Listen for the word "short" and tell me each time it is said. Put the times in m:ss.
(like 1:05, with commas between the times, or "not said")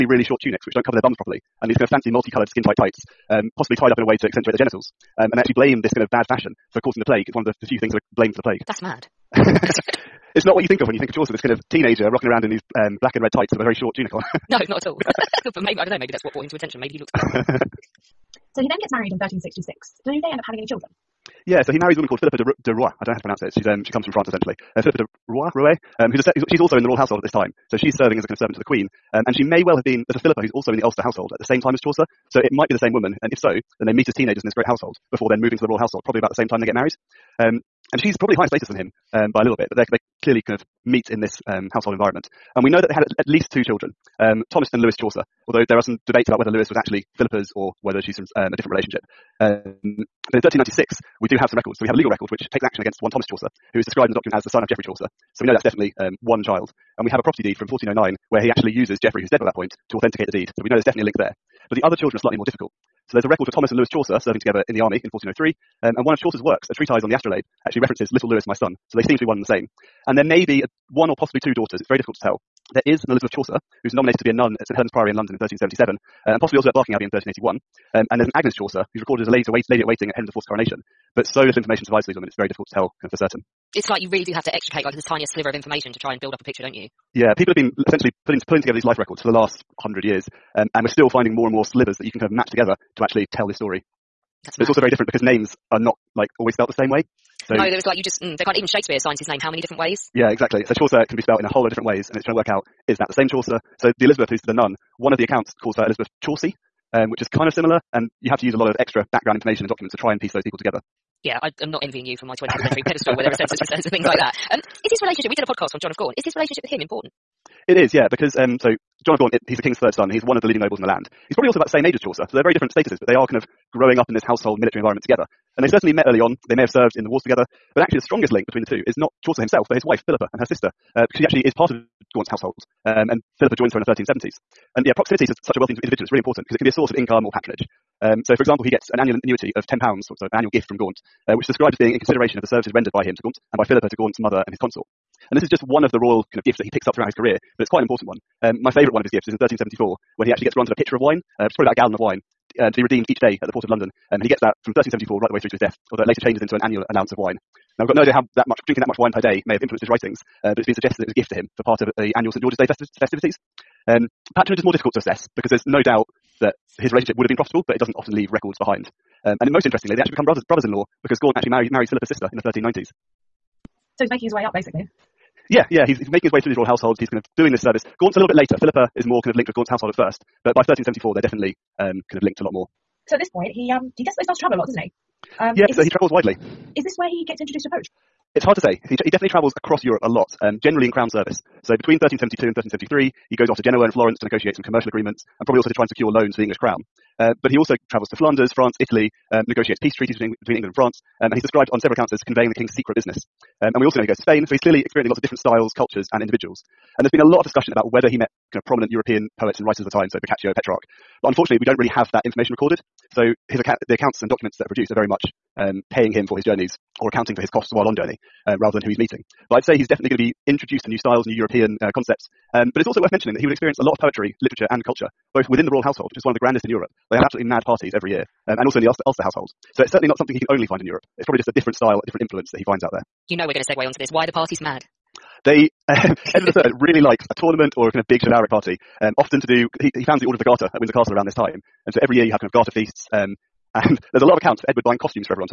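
0:00, 0:13.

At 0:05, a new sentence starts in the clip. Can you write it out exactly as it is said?
Um, and they actually blame this kind of bad fashion for causing the plague.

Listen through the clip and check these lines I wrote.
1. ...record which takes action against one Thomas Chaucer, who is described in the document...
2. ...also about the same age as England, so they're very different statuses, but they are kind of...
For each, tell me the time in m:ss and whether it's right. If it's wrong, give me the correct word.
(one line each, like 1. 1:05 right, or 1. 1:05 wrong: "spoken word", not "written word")
1. 0:52 right
2. 2:01 wrong: "Chaucer", not "England".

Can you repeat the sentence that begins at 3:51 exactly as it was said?
It's probably just a different style, a different influence that he finds out there.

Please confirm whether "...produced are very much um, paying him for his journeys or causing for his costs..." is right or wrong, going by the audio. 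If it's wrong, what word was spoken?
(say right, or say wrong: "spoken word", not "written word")
wrong: "accounting", not "causing".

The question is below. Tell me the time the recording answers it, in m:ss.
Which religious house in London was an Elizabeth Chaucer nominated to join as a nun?
1:14.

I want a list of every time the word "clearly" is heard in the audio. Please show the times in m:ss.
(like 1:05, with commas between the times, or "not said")
0:40, 3:24.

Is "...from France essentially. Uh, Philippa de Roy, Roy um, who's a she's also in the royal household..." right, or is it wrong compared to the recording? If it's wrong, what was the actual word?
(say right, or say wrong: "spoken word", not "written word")
right.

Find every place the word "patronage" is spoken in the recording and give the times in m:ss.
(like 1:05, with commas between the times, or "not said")
2:17, 2:44.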